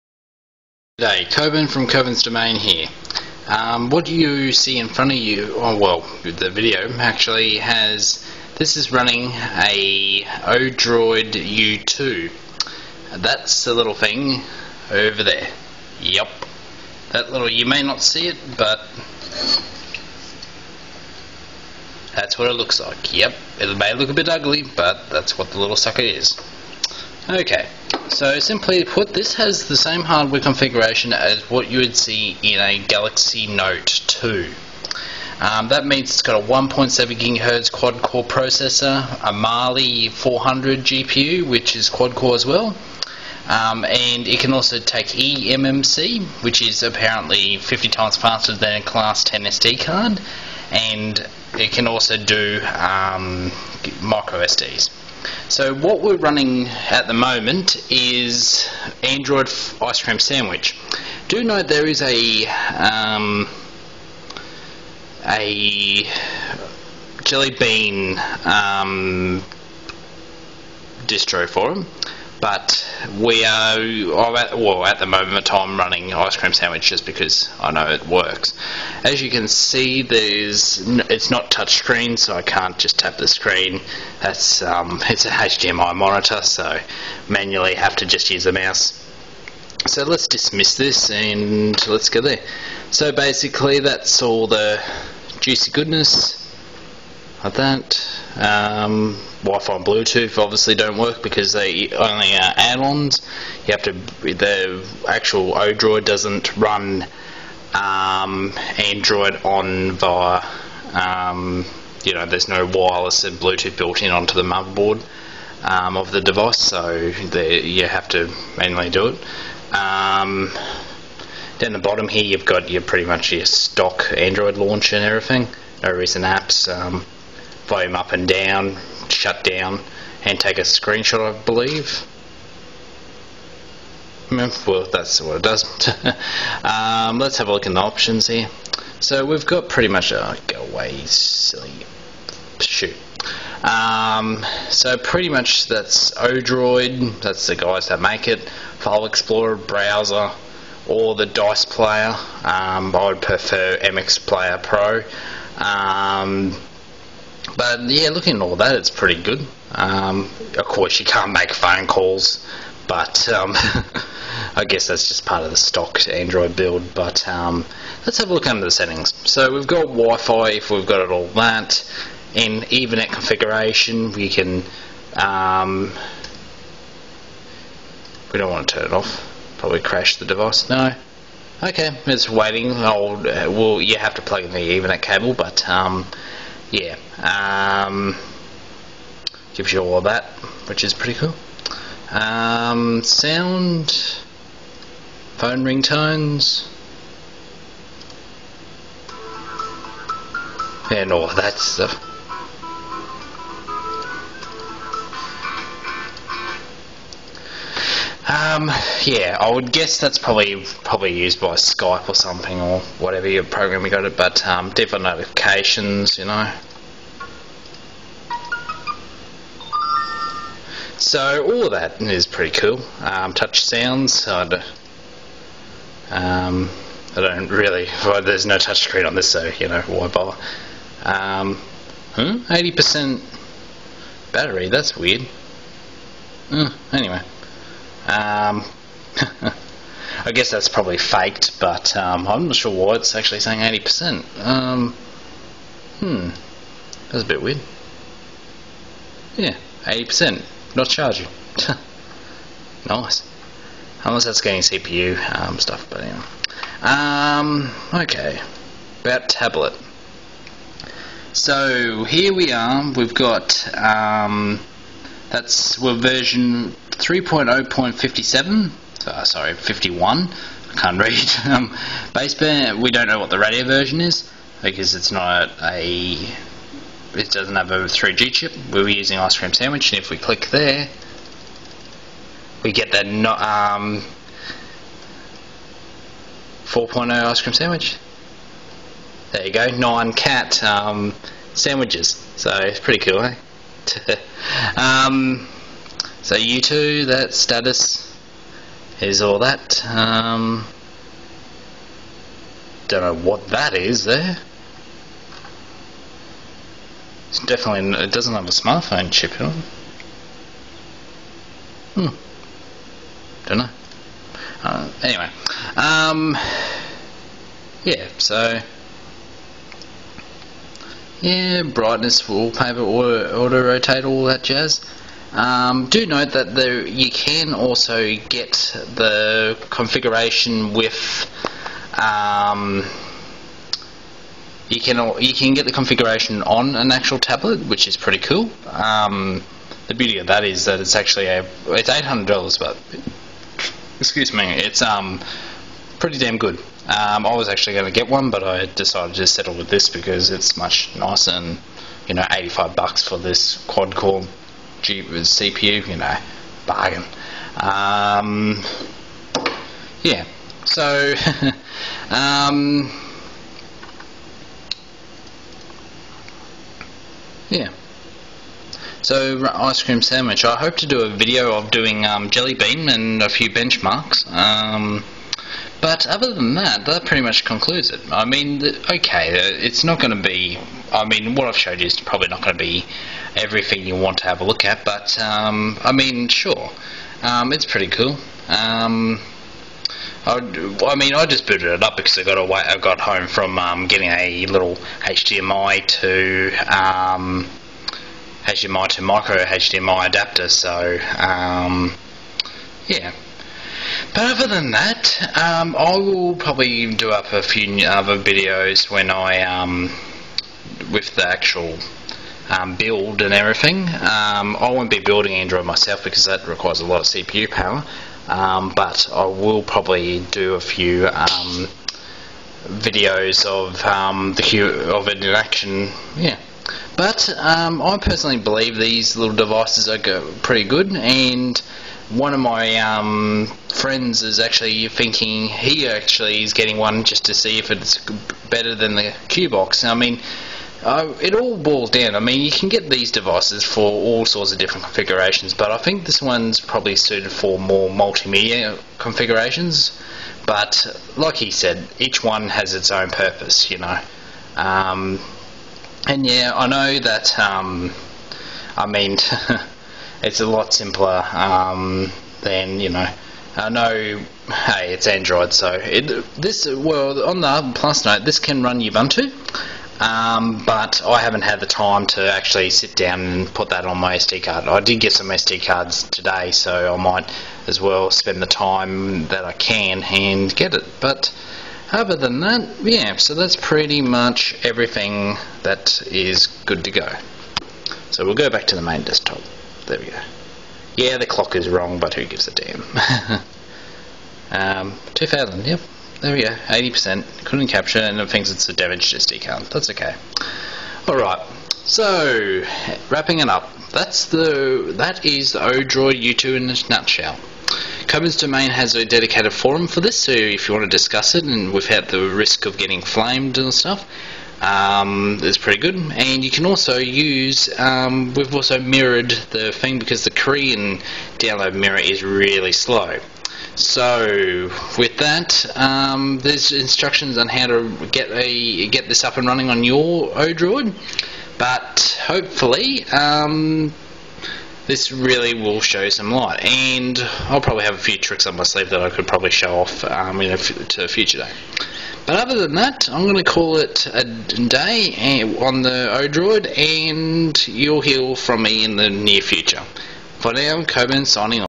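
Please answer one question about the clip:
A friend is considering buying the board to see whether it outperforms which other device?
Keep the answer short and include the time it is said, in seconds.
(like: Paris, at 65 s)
Q box, at 439 s.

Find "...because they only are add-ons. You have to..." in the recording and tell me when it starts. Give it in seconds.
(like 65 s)
101 s.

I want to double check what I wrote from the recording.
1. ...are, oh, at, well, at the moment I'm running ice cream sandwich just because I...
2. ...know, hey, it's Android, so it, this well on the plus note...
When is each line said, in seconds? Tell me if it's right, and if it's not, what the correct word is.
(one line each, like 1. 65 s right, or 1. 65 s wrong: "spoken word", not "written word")
1. 73 s right
2. 463 s right.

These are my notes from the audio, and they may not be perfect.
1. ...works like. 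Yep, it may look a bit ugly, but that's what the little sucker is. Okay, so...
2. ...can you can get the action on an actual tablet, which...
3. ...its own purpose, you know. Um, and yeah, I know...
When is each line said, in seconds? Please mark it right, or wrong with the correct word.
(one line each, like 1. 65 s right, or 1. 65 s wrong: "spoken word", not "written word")
1. 22 s wrong: "looks", not "works"
2. 334 s wrong: "configuration", not "action"
3. 452 s right.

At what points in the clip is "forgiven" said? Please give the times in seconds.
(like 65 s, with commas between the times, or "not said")
not said.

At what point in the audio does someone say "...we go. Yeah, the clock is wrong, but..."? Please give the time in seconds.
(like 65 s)
489 s.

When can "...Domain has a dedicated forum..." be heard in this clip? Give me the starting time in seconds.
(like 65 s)
508 s.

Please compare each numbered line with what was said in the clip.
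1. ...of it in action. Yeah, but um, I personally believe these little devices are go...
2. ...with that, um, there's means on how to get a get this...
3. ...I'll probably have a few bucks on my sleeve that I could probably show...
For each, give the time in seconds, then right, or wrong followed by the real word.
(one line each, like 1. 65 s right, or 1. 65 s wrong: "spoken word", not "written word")
1. 424 s right
2. 524 s wrong: "instructions", not "means"
3. 537 s wrong: "tricks", not "bucks".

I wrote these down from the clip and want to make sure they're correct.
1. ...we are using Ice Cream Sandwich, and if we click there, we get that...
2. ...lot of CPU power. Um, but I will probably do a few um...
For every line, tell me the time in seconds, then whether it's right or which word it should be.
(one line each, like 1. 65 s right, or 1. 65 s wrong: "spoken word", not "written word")
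1. 278 s right
2. 416 s right.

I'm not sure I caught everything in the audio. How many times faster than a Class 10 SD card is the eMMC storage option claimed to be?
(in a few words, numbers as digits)
50.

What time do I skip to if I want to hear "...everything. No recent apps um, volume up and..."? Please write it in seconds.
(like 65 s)
125 s.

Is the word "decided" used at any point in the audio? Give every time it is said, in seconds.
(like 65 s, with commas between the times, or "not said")
348 s.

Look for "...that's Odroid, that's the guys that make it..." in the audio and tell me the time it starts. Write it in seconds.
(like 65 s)
145 s.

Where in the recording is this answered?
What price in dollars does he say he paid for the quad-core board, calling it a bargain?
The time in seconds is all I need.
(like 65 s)
352 s.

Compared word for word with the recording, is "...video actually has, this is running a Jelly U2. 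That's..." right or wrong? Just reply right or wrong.
wrong.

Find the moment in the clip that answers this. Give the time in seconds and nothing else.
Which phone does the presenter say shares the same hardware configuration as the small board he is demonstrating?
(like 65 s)
32 s.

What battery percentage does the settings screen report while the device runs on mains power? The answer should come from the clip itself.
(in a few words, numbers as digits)
80%.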